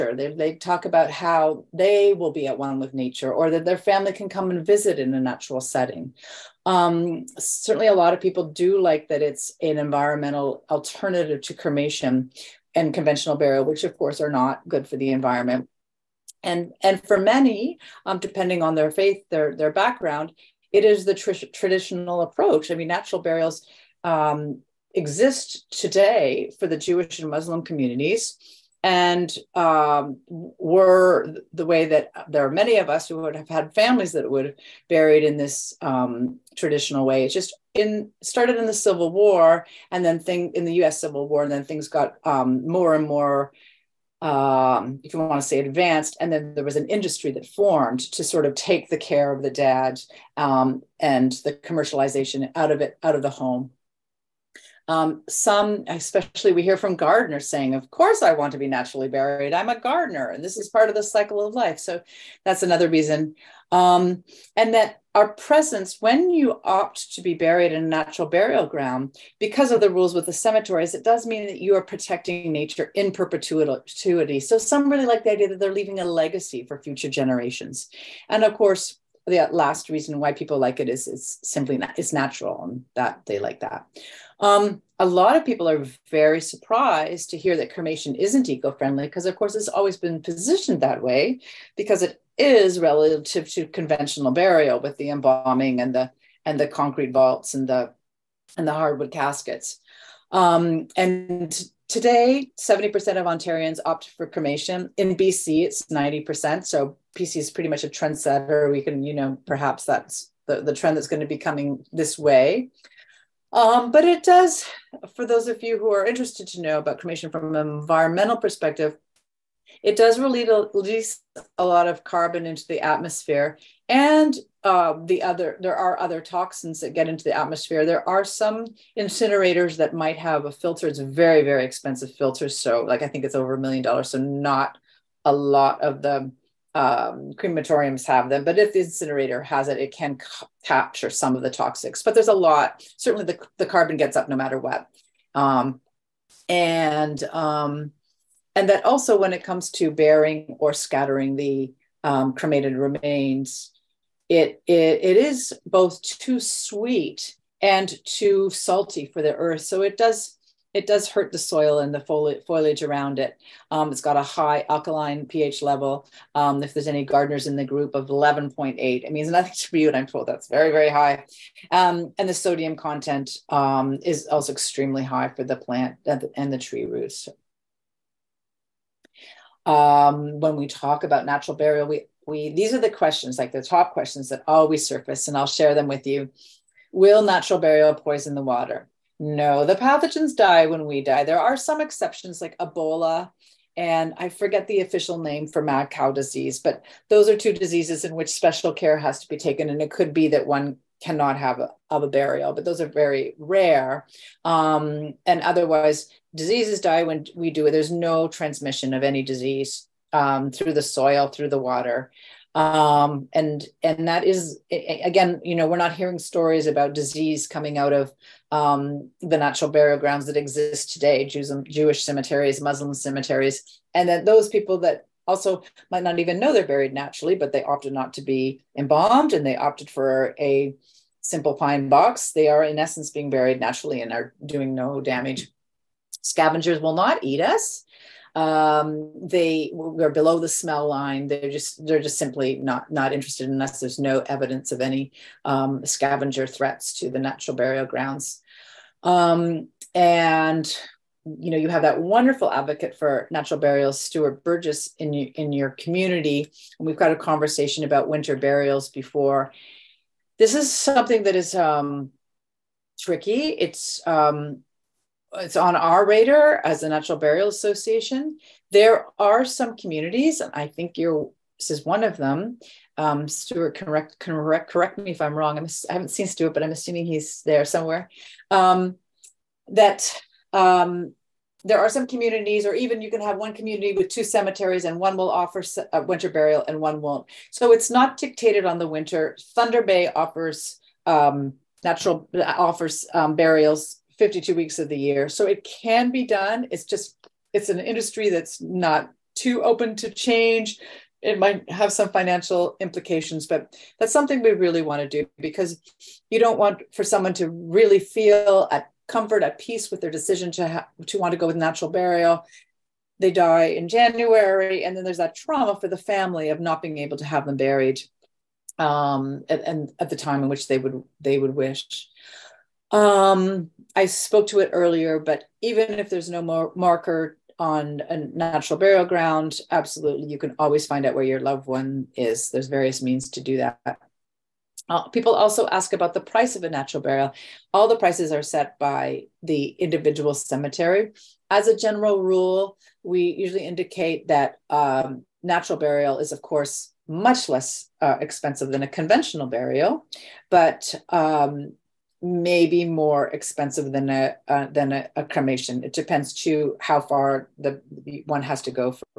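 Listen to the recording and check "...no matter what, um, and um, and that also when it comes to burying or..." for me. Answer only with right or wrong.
right.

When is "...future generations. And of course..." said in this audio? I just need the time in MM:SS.
01:16.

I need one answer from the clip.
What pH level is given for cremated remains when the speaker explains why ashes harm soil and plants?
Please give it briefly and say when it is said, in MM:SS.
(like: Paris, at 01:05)
11.8, at 02:48.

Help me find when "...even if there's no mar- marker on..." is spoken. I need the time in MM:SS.
05:25.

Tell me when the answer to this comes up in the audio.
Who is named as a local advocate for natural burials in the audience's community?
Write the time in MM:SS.
04:14.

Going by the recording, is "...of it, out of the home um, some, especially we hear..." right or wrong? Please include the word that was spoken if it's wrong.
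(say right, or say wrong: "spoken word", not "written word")
right.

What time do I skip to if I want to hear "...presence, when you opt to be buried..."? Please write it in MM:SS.
01:05.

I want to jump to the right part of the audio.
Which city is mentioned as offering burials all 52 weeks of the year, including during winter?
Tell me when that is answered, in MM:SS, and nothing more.
04:49.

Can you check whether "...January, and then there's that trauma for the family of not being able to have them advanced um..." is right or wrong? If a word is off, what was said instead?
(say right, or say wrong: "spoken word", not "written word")
wrong: "buried", not "advanced".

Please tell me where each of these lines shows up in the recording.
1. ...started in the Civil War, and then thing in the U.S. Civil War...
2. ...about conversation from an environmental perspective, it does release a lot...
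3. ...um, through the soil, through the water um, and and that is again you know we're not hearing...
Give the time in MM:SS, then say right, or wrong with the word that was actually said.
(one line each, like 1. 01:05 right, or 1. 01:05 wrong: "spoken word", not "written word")
1. 00:38 right
2. 01:56 wrong: "cremation", not "conversation"
3. 03:30 right.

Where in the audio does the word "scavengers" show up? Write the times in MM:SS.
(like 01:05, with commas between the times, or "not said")
03:56, 04:05.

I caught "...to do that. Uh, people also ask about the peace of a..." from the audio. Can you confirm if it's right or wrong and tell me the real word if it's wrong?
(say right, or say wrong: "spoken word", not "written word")
wrong: "price", not "peace".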